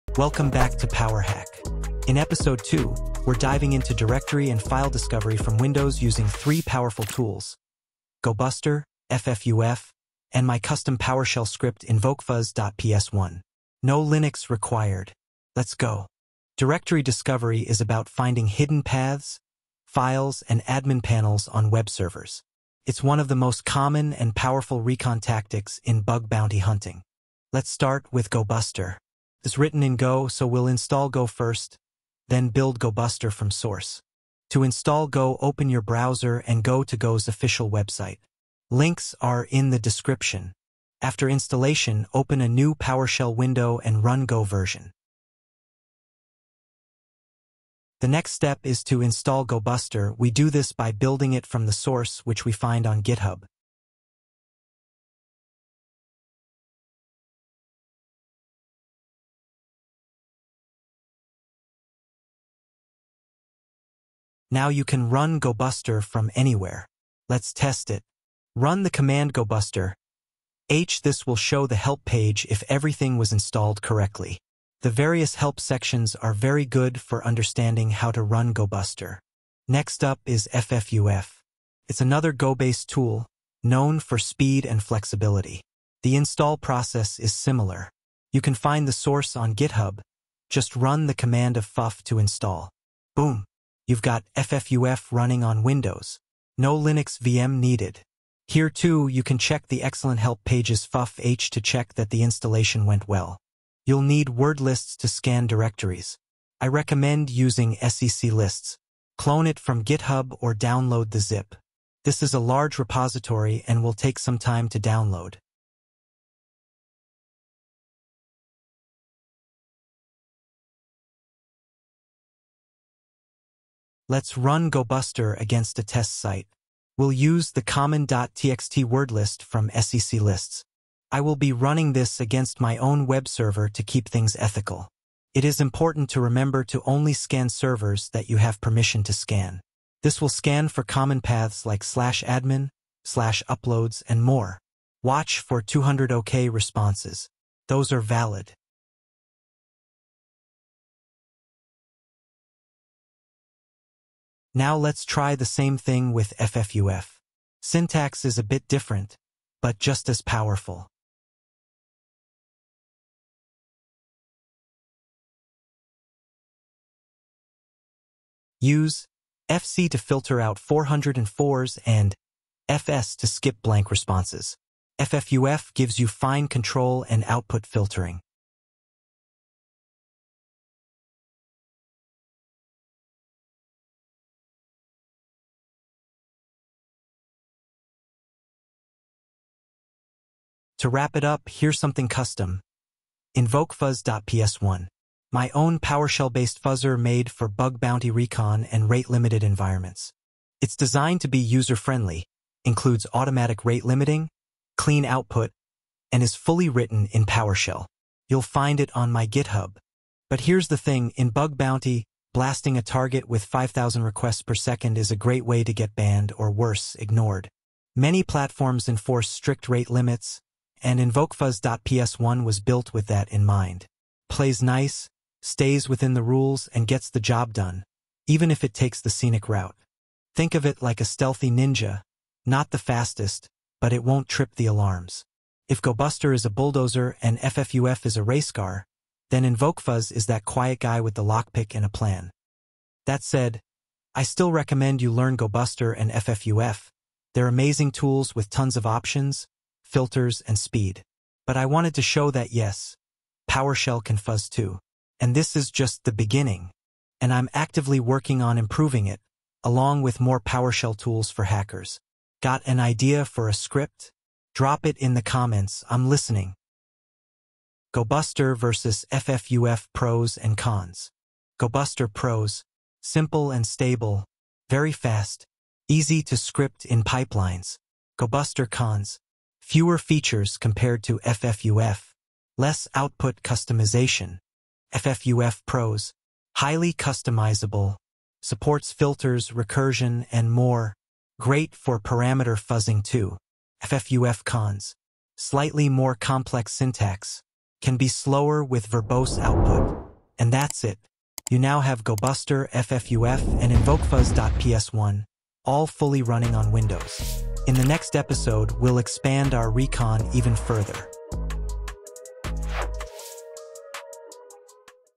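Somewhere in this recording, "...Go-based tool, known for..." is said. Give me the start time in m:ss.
1:22.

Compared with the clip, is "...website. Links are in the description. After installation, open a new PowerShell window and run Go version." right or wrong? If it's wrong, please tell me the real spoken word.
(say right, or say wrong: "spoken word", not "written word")
right.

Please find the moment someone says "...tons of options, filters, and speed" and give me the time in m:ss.
4:08.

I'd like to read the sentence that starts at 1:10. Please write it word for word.
H this will show the help page if everything was installed correctly.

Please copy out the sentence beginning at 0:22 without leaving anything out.
It's one of the most common and powerful recon tactics in bug bounty hunting.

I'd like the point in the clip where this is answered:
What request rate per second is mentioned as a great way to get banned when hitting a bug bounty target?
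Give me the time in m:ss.
3:33.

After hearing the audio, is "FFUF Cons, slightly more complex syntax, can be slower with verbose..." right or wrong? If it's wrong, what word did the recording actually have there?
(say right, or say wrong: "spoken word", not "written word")
right.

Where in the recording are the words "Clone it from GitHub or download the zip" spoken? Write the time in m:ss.
1:49.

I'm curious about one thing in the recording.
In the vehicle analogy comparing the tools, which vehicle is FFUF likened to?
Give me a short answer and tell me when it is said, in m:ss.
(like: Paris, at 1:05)
race car, at 3:58.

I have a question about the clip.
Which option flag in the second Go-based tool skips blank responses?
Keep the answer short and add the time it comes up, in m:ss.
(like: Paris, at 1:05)
FS, at 2:52.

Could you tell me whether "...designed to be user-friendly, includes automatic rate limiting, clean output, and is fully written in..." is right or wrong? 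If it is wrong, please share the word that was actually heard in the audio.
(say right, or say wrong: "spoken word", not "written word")
right.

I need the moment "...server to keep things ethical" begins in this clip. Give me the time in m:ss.
2:13.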